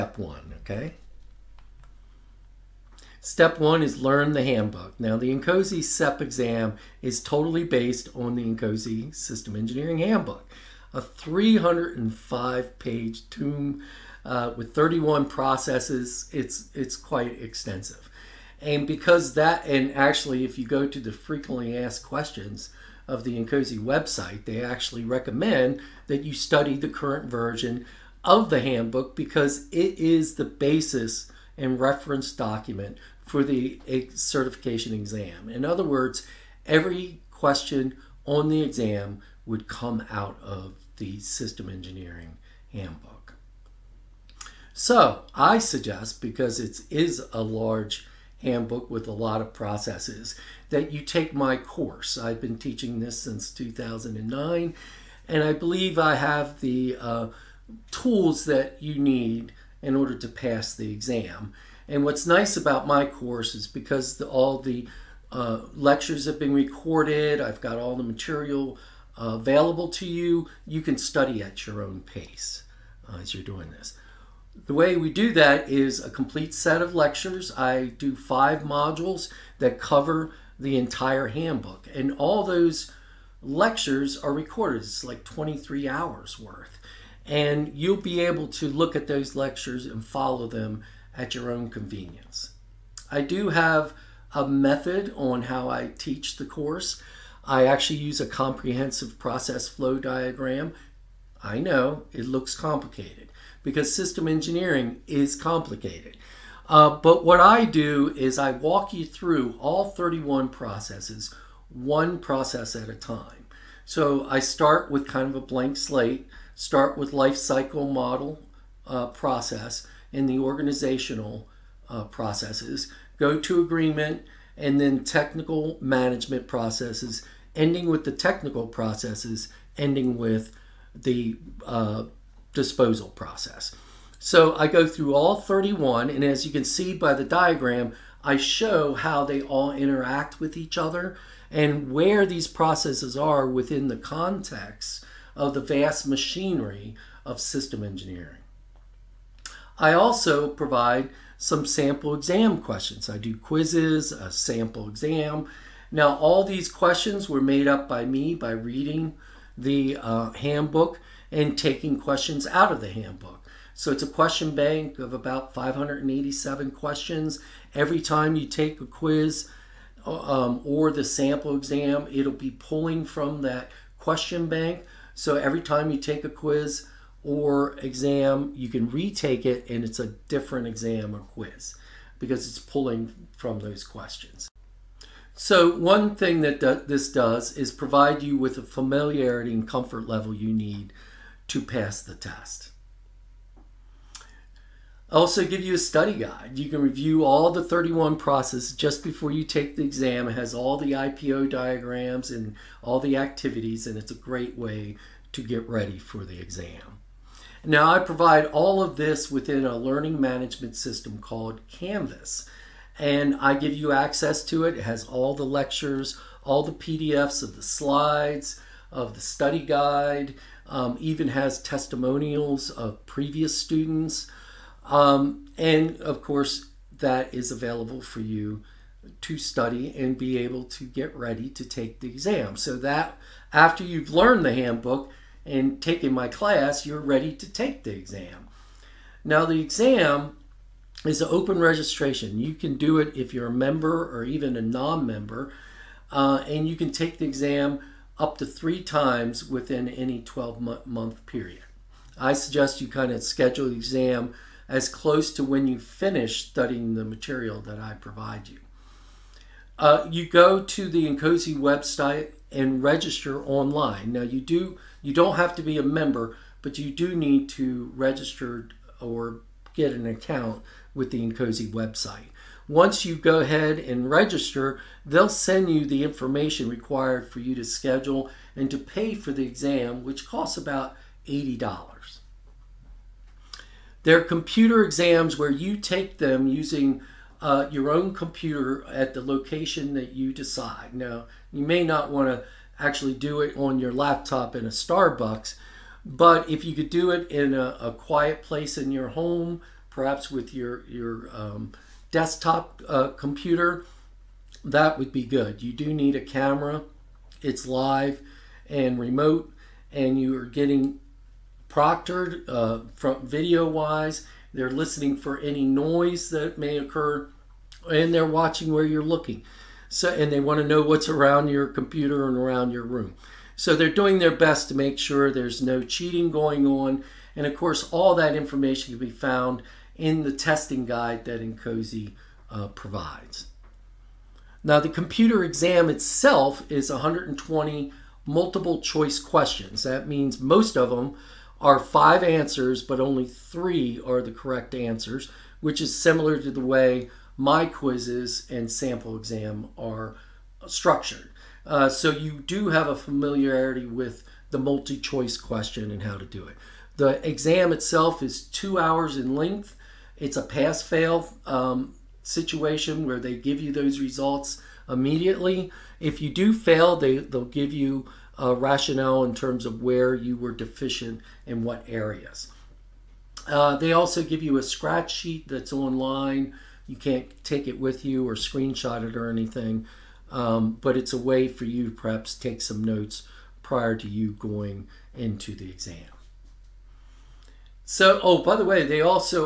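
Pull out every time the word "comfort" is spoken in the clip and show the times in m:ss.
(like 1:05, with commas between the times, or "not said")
3:09.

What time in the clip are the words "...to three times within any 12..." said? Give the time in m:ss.
4:08.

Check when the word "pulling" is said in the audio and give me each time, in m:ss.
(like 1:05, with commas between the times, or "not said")
2:52, 3:02.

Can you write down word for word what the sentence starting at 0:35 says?
In other words, every question on the exam would come out of the system engineering handbook.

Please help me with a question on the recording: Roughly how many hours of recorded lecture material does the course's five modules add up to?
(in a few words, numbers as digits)
23 hours.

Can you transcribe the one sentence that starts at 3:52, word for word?
So that after you've learned the handbook and taken my class, you're ready to take the exam.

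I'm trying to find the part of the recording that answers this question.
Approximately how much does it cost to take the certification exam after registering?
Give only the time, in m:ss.
4:41.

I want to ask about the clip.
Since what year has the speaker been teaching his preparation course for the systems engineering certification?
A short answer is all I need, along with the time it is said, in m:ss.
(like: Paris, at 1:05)
2009, at 0:53.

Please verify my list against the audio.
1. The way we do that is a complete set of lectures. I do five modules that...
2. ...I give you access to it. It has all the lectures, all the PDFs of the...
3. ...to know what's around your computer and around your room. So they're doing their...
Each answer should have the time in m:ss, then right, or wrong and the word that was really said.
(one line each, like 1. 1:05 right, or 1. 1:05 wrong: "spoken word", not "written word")
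1. 1:14 right
2. 3:33 right
3. 5:20 right.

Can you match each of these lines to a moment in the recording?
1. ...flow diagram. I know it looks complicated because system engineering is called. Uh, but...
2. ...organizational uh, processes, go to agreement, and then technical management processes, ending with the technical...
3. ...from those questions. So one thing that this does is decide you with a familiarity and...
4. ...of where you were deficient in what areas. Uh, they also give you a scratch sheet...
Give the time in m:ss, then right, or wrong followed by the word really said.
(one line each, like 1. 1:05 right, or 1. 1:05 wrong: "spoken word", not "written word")
1. 1:39 wrong: "complicated", not "called"
2. 2:00 right
3. 3:03 wrong: "provide", not "decide"
4. 6:09 right.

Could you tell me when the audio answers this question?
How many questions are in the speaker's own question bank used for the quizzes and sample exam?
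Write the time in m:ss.
2:45.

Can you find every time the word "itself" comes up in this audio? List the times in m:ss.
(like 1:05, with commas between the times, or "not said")
5:35, 5:57.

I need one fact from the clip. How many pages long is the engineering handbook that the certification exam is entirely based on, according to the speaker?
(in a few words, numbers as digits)
305.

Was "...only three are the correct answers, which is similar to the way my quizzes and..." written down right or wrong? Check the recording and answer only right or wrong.
right.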